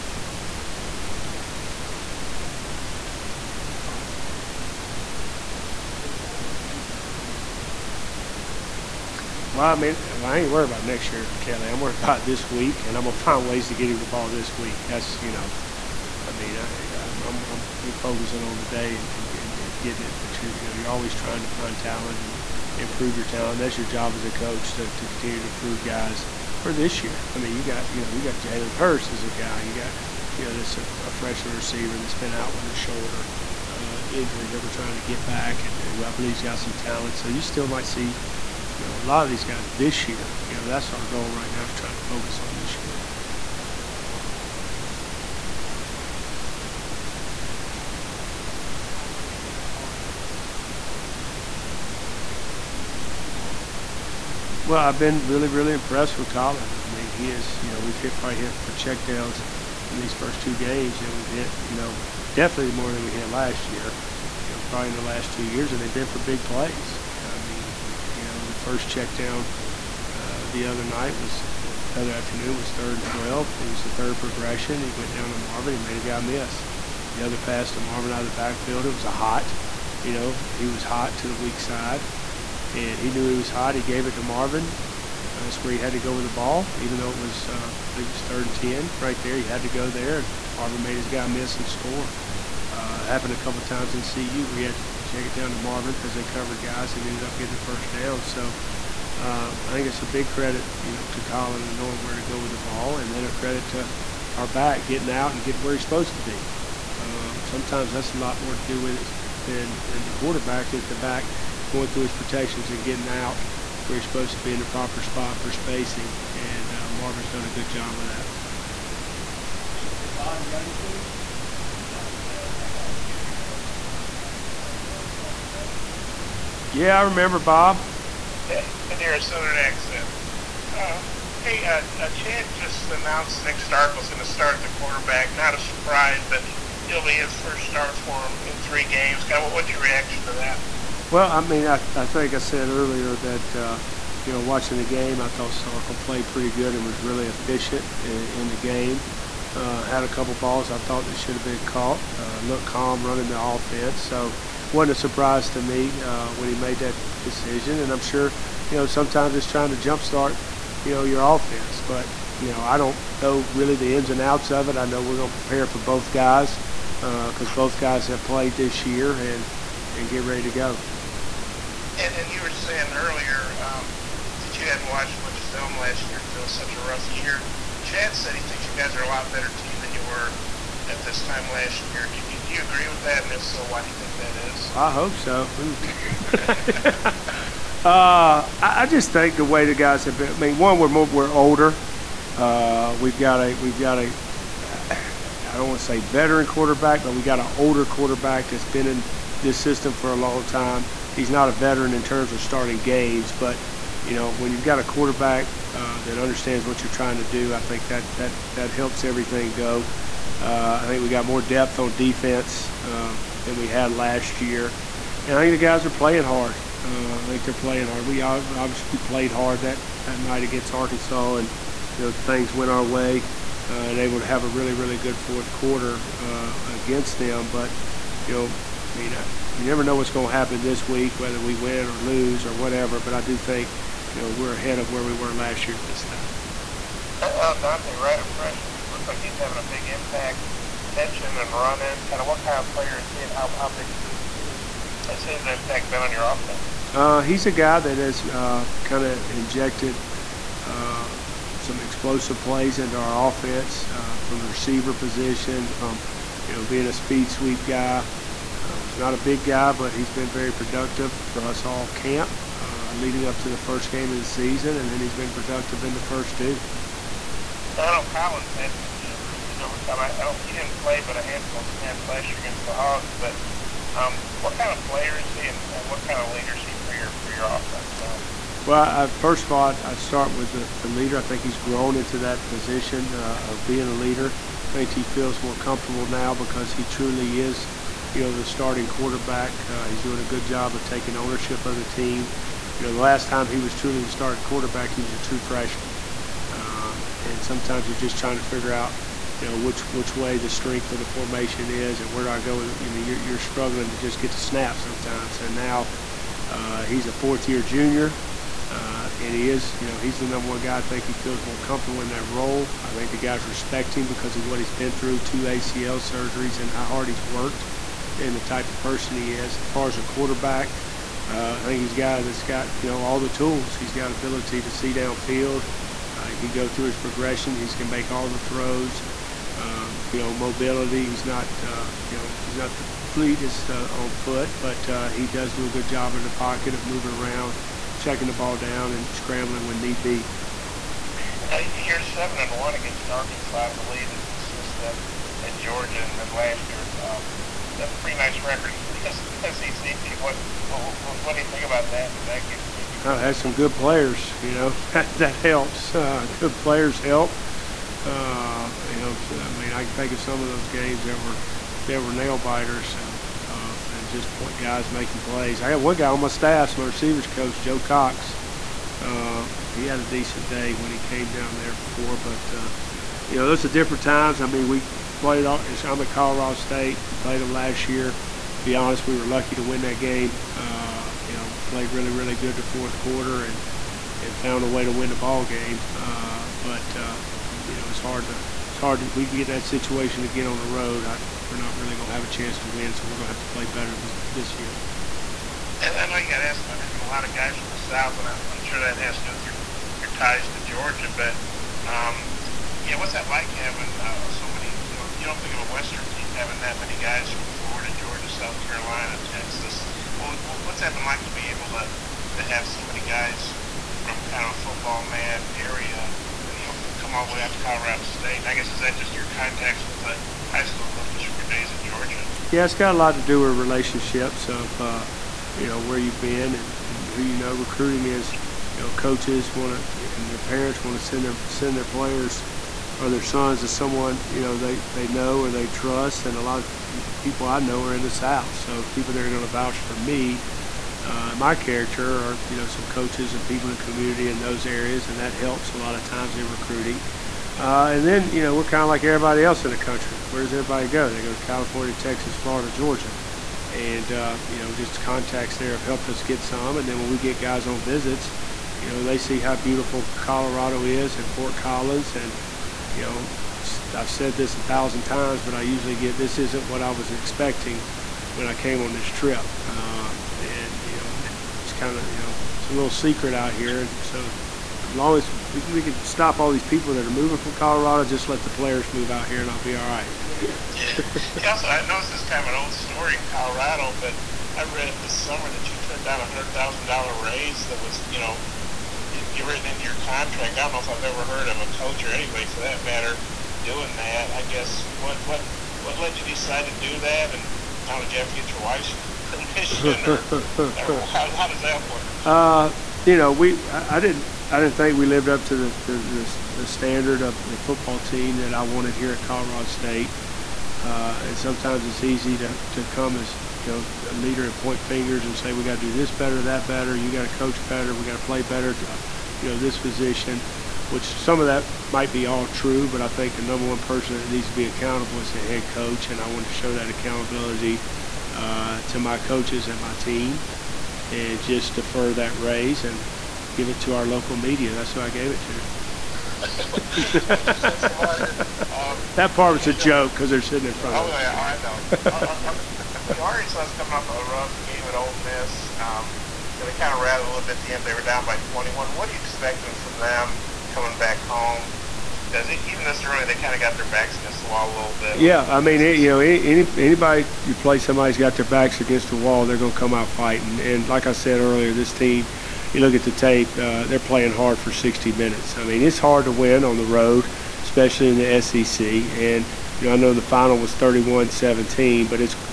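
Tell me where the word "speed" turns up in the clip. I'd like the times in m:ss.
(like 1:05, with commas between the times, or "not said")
0:47, 4:16.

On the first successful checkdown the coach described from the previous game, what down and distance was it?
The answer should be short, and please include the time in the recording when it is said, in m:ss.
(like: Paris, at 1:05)
third and 12, at 1:12.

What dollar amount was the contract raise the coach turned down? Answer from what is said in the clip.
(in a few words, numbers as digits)
$100,000.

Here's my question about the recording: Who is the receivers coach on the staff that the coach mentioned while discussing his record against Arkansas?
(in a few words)
Joe Cox.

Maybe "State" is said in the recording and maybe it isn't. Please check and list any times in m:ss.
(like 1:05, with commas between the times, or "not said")
6:16, 6:58, 8:29.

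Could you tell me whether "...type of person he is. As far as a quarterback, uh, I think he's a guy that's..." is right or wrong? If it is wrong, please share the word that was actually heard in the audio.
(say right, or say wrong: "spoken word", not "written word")
right.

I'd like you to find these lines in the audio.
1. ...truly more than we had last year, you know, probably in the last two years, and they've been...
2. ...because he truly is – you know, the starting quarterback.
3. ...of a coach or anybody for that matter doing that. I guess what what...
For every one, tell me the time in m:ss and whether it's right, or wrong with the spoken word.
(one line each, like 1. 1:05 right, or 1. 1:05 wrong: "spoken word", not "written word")
1. 1:02 wrong: "definitely", not "truly"
2. 4:46 right
3. 8:11 right.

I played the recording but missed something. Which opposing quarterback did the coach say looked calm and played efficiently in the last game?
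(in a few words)
Starkel.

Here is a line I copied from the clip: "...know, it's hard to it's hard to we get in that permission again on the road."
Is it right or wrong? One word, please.
wrong.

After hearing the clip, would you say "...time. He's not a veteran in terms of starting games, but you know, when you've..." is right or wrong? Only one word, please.
right.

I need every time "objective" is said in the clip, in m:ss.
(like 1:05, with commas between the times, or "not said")
not said.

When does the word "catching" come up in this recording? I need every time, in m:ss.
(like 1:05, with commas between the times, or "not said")
4:00.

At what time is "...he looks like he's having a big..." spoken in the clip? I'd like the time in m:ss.
3:58.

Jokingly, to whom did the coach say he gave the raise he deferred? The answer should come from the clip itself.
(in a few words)
our local media.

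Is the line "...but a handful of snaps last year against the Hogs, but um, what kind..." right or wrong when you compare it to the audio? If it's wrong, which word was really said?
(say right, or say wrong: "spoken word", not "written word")
right.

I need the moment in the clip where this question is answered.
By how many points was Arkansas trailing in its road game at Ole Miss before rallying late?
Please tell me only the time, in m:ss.
9:08.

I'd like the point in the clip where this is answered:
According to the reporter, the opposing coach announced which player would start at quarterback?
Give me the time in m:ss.
2:13.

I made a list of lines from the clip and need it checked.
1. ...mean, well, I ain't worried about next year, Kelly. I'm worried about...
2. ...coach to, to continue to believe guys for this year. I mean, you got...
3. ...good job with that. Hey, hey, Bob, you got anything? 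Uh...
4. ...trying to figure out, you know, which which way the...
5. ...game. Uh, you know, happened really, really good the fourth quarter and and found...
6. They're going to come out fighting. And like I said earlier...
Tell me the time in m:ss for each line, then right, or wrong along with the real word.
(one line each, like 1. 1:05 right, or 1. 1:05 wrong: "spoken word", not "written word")
1. 0:09 right
2. 0:24 wrong: "improve", not "believe"
3. 1:57 right
4. 4:58 right
5. 6:20 wrong: "played", not "happened"
6. 9:19 right.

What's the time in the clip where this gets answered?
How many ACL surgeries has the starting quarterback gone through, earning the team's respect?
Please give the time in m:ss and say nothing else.
5:15.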